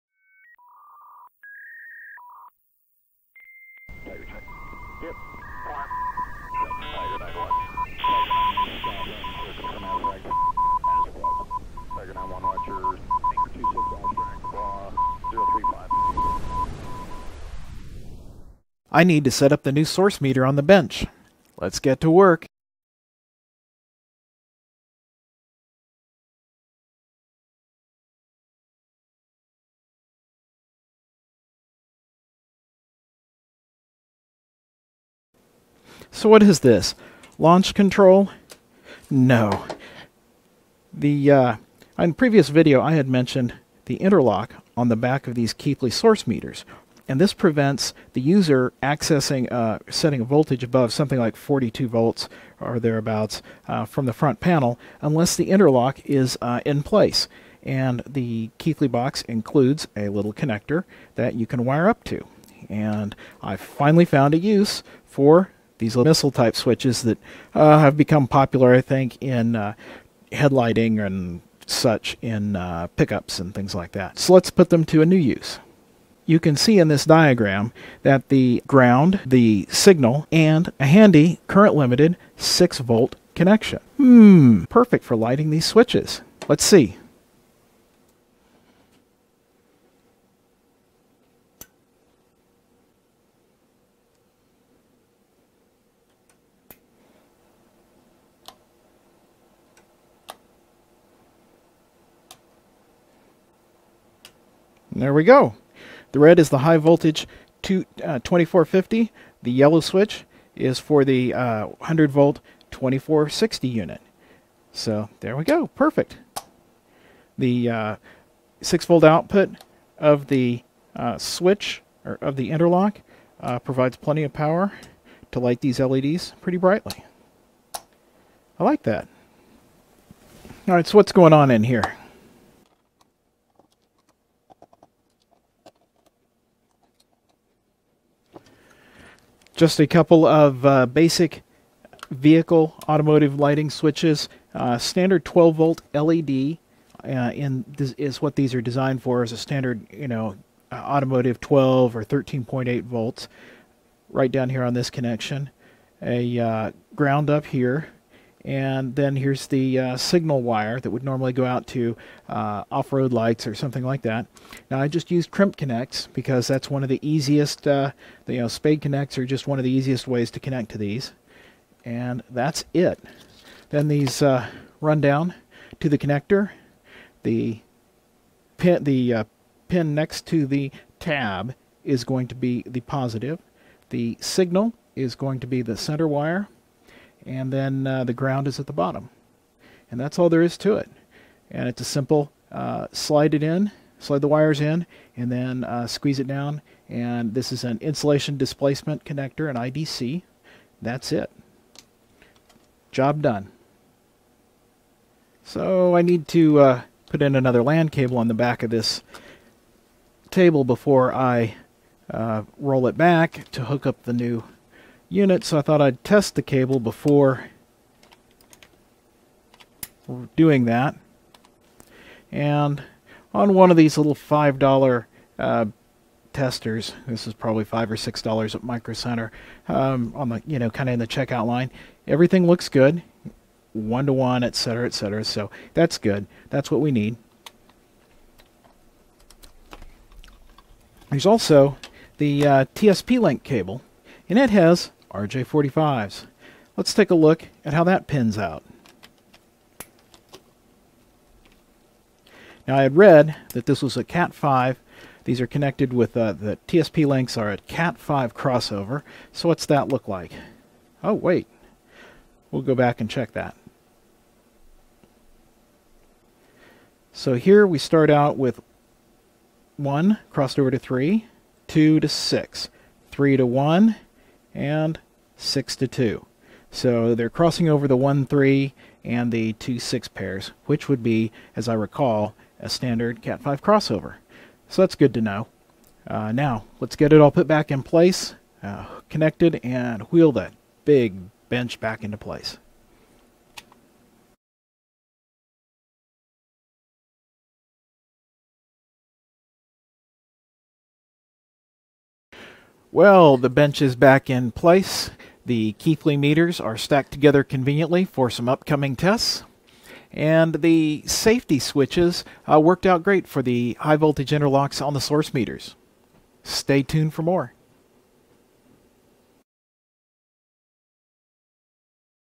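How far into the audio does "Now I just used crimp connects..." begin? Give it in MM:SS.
02:44.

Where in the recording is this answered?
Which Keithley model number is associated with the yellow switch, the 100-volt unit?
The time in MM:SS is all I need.
01:52.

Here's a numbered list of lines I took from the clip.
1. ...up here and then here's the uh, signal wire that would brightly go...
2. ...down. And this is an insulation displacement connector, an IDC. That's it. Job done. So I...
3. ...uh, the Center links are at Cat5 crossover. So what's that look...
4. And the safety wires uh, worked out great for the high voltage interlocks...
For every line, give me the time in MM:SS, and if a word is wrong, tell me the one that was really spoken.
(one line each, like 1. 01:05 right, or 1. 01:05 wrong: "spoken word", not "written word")
1. 02:37 wrong: "normally", not "brightly"
2. 03:16 right
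3. 04:16 wrong: "TSP", not "Center"
4. 05:10 wrong: "switches", not "wires".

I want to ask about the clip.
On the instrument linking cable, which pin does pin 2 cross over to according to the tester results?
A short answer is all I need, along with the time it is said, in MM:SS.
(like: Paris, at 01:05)
6, at 04:31.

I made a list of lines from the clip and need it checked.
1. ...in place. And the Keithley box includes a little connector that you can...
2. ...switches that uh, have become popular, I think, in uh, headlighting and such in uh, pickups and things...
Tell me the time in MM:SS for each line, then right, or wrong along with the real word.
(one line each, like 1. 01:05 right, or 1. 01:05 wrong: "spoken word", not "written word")
1. 00:56 right
2. 01:06 right.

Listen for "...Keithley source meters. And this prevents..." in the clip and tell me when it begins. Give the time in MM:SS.
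00:45.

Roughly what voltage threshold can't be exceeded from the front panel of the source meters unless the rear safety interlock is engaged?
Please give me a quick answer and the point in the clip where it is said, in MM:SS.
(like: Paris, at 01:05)
42 volts, at 00:51.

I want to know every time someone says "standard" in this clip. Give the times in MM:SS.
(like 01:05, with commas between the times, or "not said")
02:24, 02:29, 04:42.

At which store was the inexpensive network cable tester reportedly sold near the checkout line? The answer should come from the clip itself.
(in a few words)
Micro Center.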